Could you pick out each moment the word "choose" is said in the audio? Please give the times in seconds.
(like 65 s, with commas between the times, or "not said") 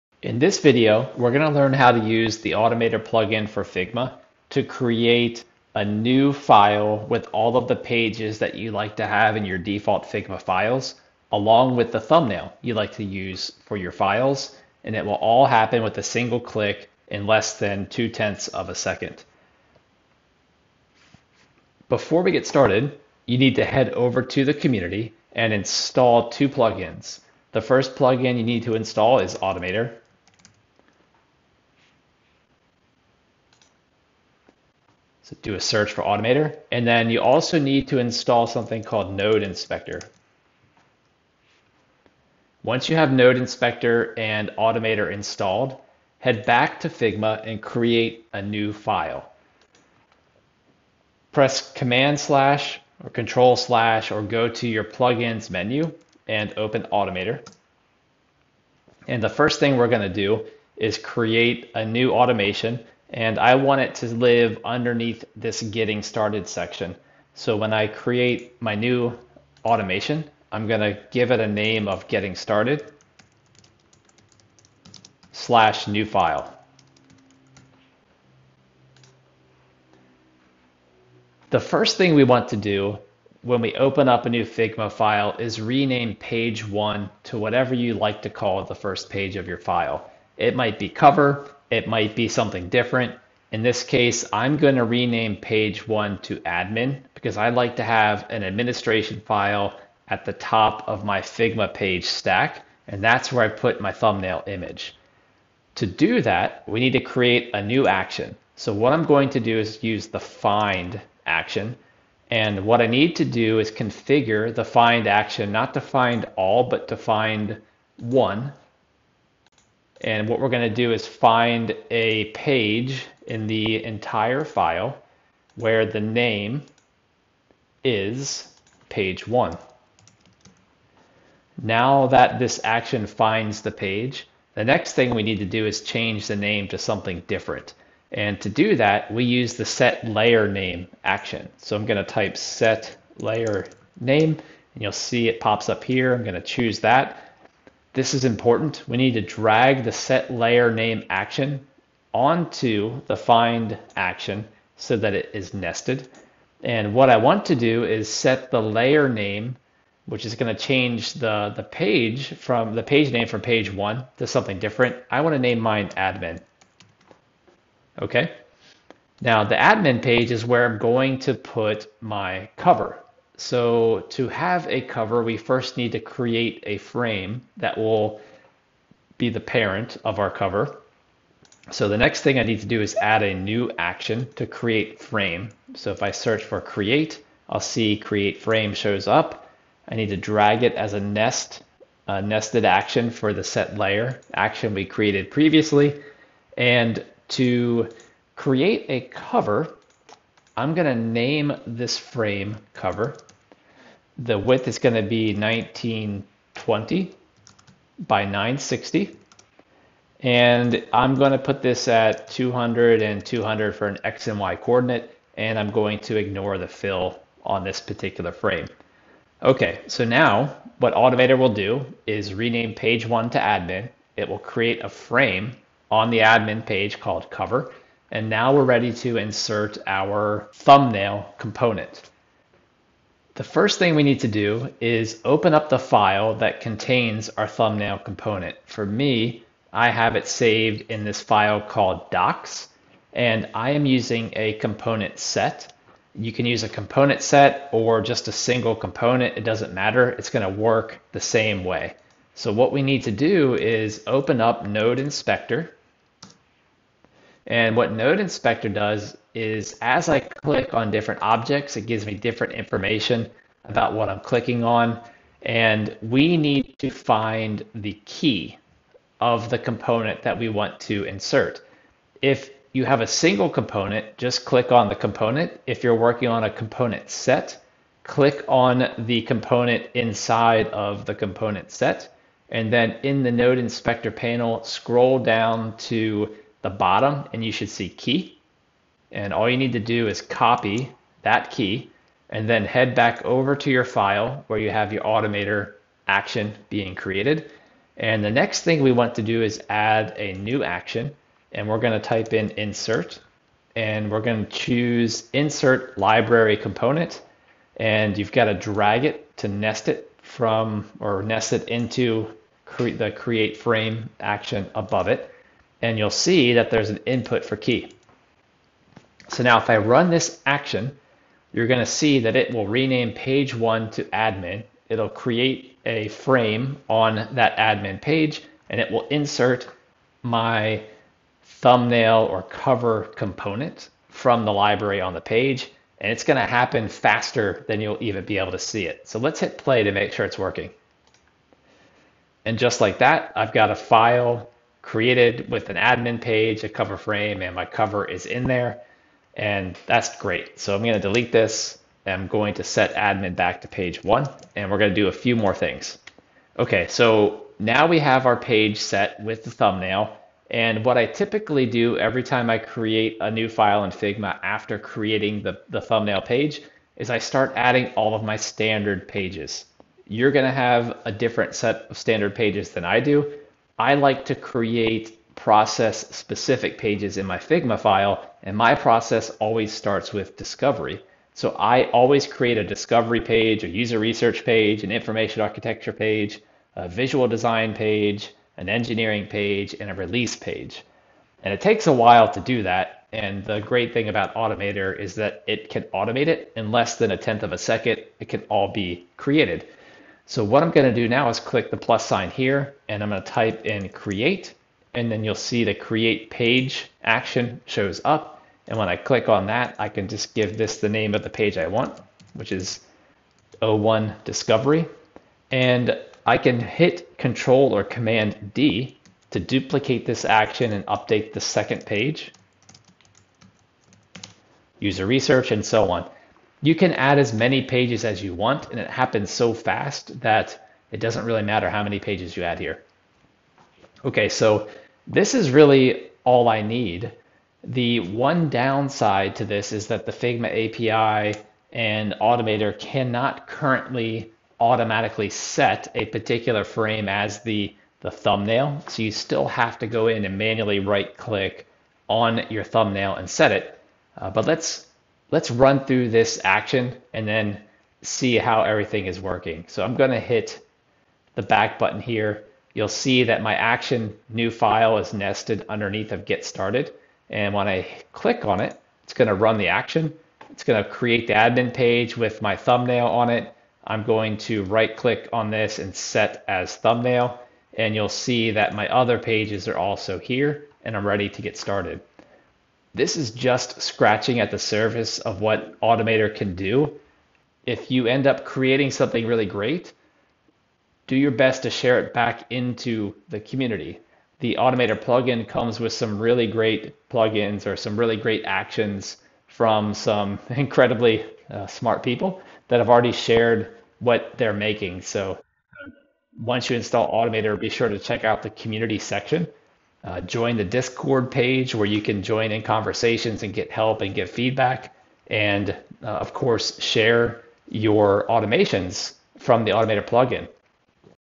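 146 s, 304 s.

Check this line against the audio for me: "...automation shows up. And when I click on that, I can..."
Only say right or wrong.
wrong.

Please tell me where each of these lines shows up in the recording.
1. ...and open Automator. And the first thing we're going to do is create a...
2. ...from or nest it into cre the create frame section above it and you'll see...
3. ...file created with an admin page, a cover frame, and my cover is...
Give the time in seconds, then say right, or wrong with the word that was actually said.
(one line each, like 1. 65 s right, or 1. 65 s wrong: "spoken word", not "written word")
1. 56 s right
2. 310 s wrong: "action", not "section"
3. 343 s right.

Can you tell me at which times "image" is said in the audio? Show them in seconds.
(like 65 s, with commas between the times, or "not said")
104 s.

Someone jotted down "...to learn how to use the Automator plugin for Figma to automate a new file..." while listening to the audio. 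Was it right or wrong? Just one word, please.
wrong.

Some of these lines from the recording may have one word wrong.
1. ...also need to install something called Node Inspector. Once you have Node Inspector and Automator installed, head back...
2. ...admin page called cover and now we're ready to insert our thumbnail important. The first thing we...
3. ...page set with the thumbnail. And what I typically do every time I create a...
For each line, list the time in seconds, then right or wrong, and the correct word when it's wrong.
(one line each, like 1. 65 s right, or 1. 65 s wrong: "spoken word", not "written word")
1. 37 s right
2. 226 s wrong: "component", not "important"
3. 358 s right.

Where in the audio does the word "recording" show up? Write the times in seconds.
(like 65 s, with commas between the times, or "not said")
not said.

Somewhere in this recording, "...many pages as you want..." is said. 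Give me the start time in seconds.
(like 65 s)
427 s.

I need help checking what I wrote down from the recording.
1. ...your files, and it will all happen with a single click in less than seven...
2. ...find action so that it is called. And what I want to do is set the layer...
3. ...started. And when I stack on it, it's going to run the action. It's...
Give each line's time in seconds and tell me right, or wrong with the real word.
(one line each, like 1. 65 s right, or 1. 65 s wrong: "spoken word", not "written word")
1. 13 s wrong: "two", not "seven"
2. 153 s wrong: "nested", not "called"
3. 466 s wrong: "click", not "stack".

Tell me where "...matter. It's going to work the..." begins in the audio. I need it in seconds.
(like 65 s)
249 s.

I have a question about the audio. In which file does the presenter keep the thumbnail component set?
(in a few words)
docs.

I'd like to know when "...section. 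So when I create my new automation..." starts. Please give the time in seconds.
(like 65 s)
66 s.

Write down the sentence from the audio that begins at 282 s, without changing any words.
And then in the node inspector panel, scroll down to the bottom and you should see key.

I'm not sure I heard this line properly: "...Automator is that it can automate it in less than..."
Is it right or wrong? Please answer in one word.
right.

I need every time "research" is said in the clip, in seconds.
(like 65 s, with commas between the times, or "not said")
383 s, 425 s.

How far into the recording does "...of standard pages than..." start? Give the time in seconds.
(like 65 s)
371 s.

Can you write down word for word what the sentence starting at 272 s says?
If you have a single component, just click on the component.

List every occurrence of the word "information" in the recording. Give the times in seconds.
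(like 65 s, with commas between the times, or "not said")
262 s, 384 s.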